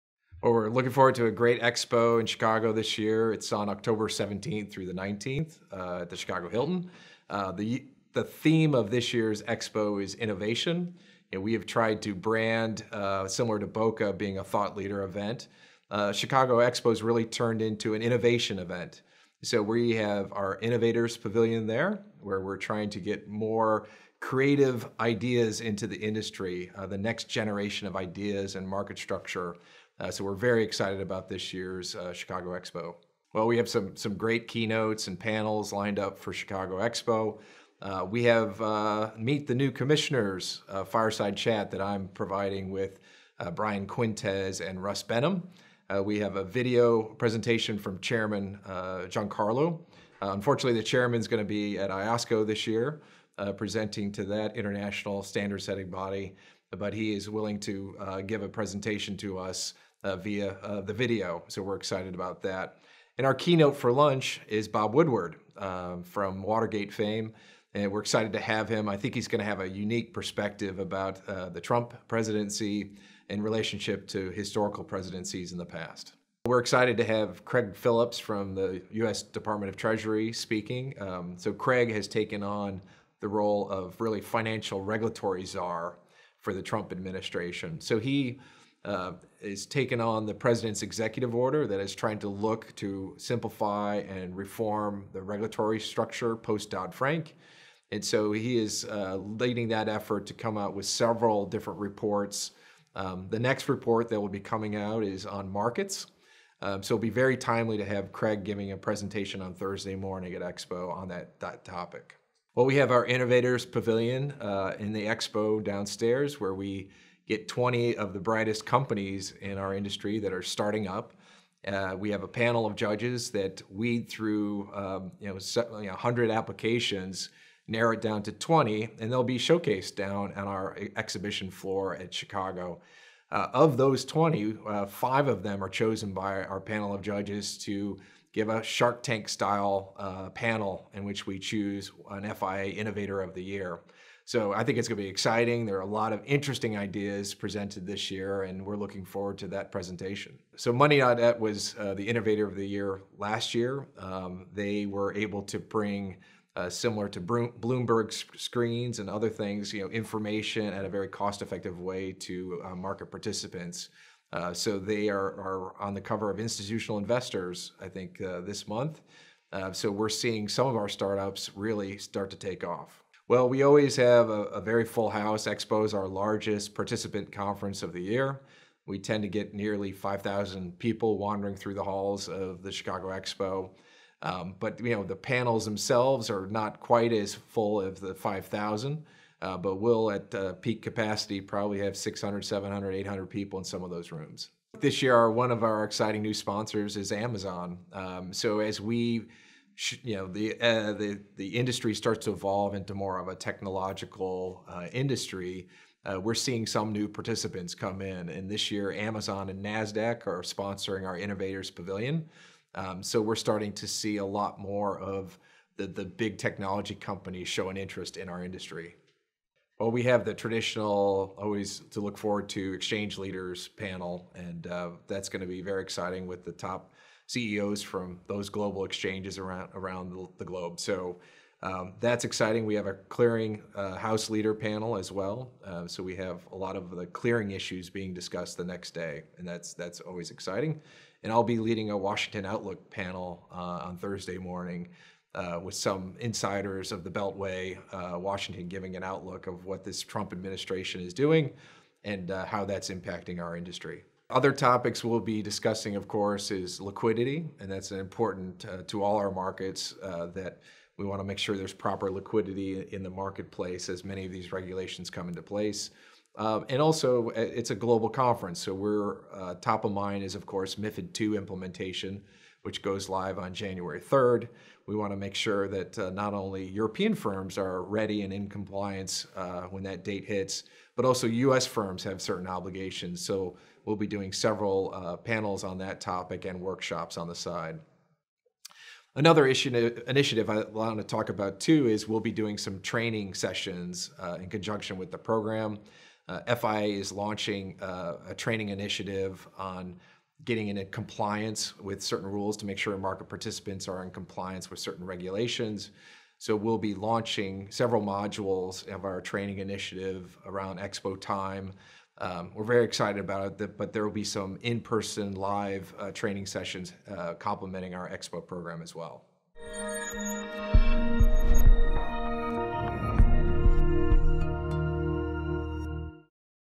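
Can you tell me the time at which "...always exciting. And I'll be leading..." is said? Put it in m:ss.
4:00.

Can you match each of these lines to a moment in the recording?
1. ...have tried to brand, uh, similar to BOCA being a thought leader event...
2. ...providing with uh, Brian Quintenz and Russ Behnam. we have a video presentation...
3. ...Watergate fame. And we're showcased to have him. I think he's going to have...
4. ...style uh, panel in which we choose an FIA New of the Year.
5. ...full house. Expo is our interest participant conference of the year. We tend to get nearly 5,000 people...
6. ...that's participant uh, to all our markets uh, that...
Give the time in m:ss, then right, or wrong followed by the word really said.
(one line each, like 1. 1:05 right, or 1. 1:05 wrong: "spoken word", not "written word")
1. 0:11 right
2. 0:42 right
3. 1:06 wrong: "excited", not "showcased"
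4. 2:19 wrong: "Innovator", not "New"
5. 2:54 wrong: "largest", not "interest"
6. 4:17 wrong: "important", not "participant".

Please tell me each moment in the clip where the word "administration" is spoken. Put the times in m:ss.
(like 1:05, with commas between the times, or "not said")
1:26, 4:10.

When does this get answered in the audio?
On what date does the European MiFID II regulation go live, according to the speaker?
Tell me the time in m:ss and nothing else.
4:33.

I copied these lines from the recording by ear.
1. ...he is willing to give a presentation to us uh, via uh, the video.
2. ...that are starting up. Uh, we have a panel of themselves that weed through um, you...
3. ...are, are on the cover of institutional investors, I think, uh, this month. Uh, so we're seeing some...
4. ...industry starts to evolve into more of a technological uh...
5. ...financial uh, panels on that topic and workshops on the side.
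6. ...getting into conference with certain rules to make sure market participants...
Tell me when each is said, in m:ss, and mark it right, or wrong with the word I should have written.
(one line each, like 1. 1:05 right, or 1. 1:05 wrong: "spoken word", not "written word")
1. 0:56 right
2. 2:00 wrong: "judges", not "themselves"
3. 2:45 right
4. 3:21 right
5. 4:44 wrong: "several", not "financial"
6. 5:00 wrong: "compliance", not "conference".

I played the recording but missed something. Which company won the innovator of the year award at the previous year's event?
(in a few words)
Money.net.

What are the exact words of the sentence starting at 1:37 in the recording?
And so he is uh, leading that effort to come out with several different reports.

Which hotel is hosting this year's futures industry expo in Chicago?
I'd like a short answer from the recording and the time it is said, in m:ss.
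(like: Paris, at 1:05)
Chicago Hilton, at 0:06.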